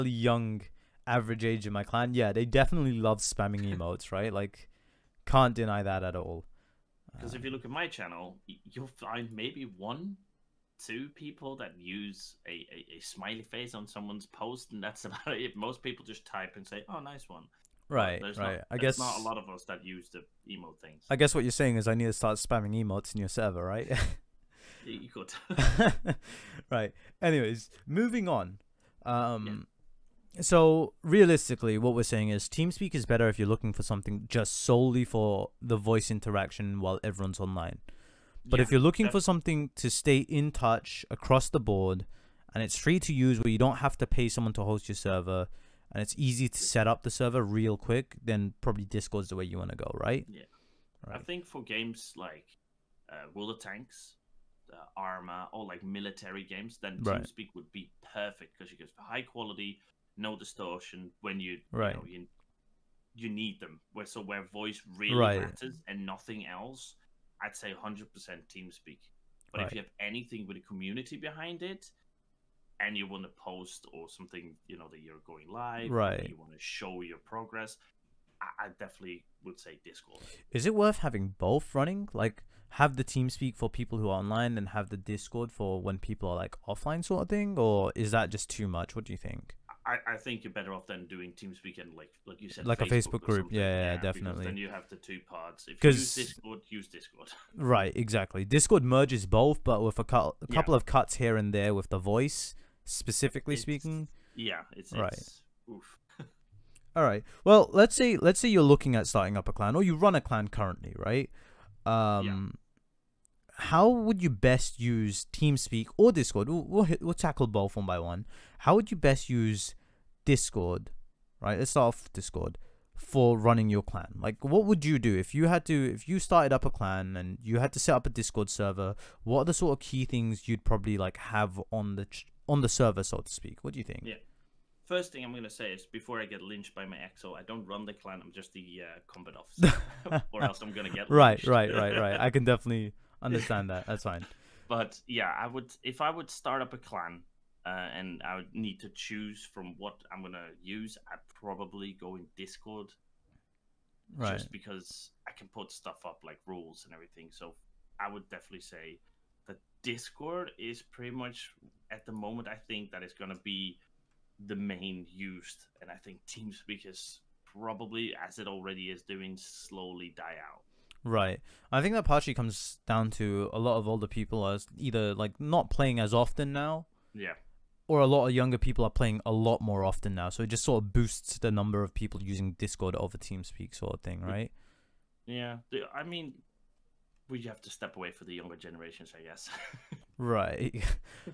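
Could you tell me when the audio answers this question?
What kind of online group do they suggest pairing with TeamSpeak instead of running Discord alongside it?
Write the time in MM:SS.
01:32.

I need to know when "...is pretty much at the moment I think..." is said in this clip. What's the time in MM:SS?
02:40.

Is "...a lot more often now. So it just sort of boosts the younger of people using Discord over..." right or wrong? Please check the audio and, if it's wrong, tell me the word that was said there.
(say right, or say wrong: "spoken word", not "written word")
wrong: "number", not "younger".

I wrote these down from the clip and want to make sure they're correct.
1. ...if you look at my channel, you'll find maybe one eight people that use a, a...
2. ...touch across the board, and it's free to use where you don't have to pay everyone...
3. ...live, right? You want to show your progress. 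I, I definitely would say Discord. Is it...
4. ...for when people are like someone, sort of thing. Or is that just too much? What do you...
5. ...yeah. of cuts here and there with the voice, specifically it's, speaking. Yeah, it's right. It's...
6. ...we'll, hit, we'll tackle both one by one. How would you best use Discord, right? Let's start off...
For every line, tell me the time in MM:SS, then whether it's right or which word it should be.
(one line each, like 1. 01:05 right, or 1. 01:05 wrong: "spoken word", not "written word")
1. 00:07 wrong: "two", not "eight"
2. 00:40 wrong: "someone", not "everyone"
3. 01:15 right
4. 01:25 wrong: "offline", not "someone"
5. 01:40 right
6. 01:56 right.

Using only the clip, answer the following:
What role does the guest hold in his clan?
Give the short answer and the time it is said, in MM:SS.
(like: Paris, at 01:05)
combat officer, at 02:19.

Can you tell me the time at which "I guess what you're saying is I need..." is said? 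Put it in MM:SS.
00:21.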